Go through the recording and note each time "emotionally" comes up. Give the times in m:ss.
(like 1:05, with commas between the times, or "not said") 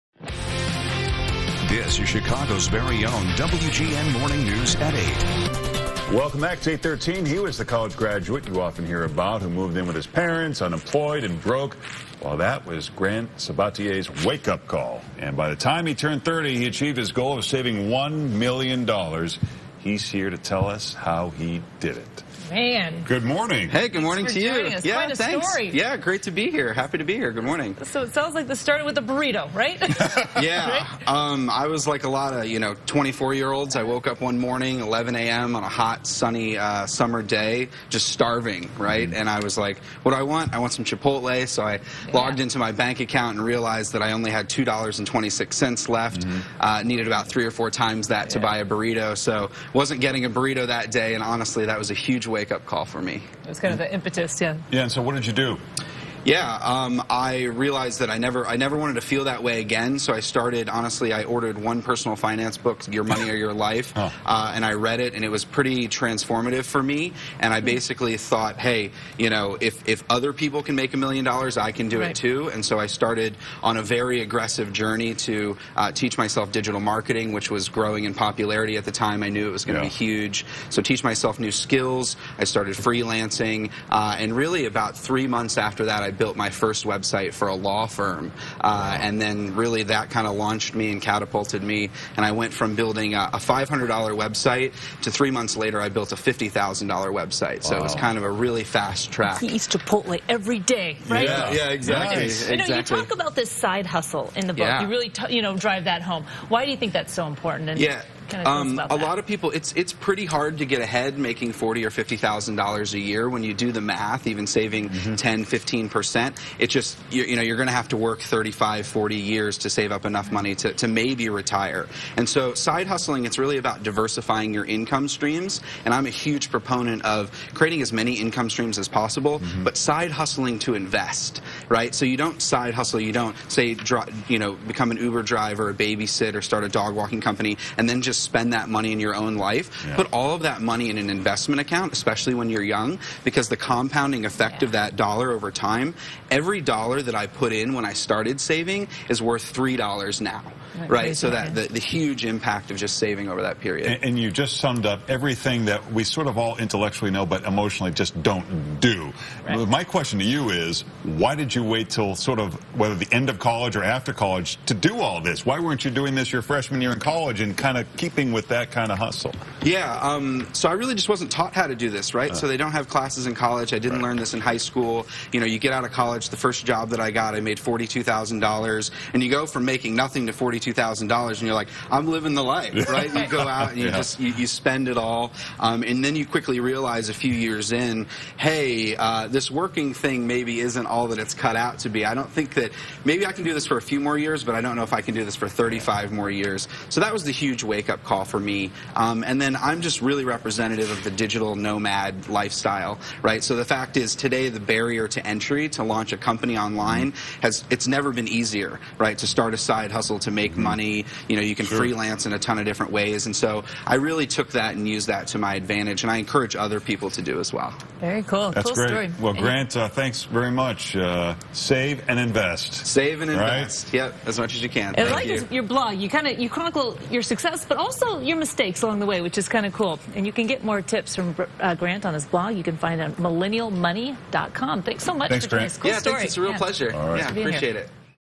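2:37.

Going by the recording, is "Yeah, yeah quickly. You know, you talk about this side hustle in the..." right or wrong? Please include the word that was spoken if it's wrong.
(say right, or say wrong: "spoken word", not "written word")
wrong: "exactly", not "quickly".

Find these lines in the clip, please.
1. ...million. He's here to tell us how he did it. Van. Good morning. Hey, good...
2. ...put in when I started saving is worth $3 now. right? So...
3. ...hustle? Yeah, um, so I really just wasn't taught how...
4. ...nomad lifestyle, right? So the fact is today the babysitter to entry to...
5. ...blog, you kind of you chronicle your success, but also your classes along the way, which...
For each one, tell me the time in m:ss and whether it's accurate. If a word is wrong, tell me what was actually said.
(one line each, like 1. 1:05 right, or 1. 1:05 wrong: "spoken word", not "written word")
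1. 0:18 right
2. 2:27 right
3. 2:48 right
4. 3:21 wrong: "barrier", not "babysitter"
5. 3:45 wrong: "mistakes", not "classes".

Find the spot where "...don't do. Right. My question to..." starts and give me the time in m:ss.
2:38.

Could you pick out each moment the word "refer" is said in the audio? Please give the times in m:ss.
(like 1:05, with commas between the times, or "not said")
not said.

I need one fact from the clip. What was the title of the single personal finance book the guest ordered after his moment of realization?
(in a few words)
Your Money or Your Life.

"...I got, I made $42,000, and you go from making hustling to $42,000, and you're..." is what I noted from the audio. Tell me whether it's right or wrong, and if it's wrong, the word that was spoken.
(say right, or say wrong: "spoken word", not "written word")
wrong: "nothing", not "hustling".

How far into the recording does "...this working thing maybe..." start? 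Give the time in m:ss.
3:09.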